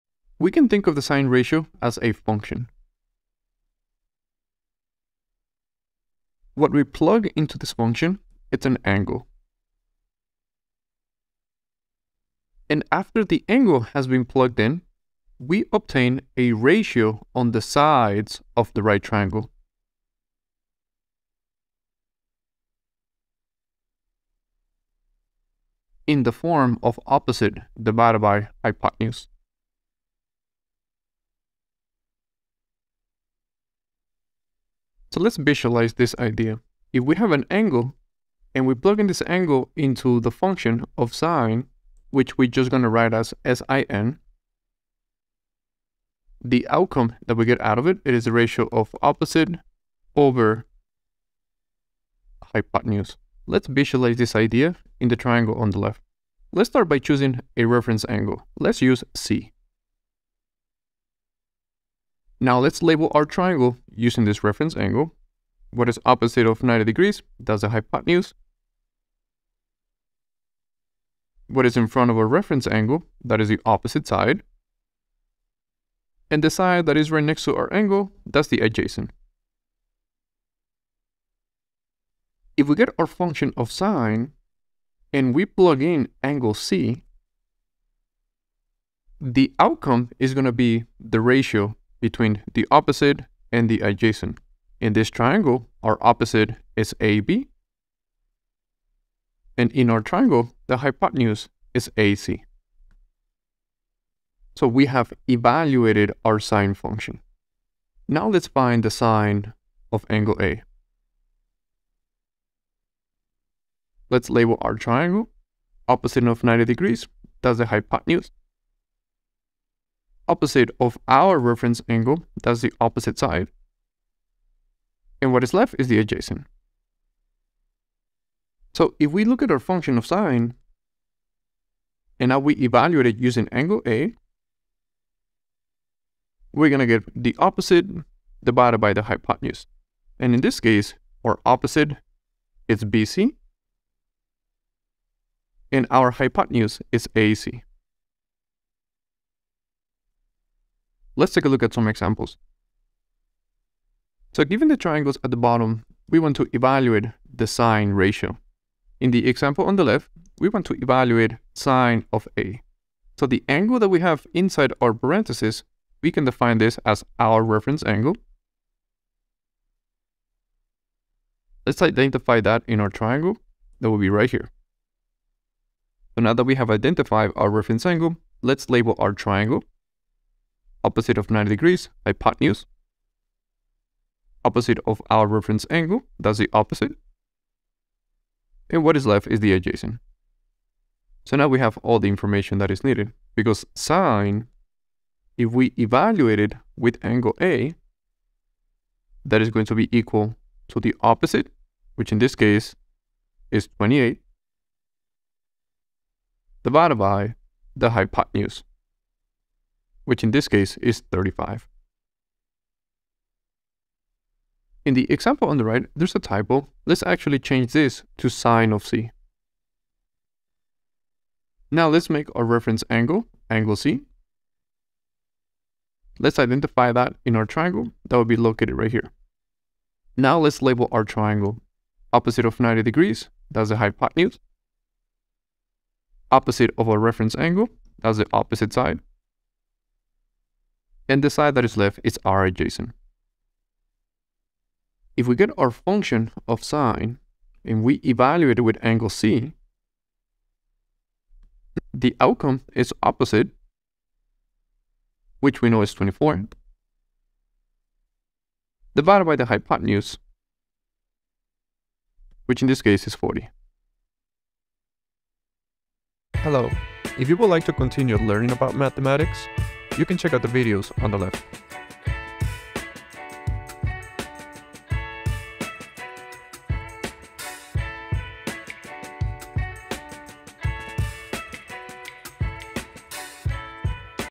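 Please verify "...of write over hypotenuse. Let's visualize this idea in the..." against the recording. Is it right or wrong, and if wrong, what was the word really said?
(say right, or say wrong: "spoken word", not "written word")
wrong: "opposite", not "write".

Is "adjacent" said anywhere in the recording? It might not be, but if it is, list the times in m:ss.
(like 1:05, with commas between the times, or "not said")
1:18, 1:33, 2:05, 3:09, 4:02.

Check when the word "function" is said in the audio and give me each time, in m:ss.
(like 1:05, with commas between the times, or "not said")
0:02, 0:07, 0:40, 1:23, 1:46, 2:09, 4:05.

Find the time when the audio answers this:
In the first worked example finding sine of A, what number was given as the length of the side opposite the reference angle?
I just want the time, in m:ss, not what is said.
3:23.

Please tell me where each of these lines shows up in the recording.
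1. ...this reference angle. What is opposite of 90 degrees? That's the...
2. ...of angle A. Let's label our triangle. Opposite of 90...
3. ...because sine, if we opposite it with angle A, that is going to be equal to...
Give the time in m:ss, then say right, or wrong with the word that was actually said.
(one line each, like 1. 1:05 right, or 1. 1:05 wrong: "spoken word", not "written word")
1. 1:04 right
2. 1:49 right
3. 3:13 wrong: "evaluate", not "opposite".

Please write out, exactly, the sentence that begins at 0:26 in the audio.
in the form of opposite divided by hypotenuse.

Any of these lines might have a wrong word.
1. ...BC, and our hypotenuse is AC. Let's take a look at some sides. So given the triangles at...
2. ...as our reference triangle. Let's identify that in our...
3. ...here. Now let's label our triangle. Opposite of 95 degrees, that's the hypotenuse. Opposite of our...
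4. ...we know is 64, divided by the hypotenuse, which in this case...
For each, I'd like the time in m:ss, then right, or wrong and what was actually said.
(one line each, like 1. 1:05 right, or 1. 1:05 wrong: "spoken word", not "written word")
1. 2:22 wrong: "examples", not "sides"
2. 2:46 wrong: "angle", not "triangle"
3. 3:48 wrong: "90", not "95"
4. 4:15 wrong: "24", not "64".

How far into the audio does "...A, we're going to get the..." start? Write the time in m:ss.
2:13.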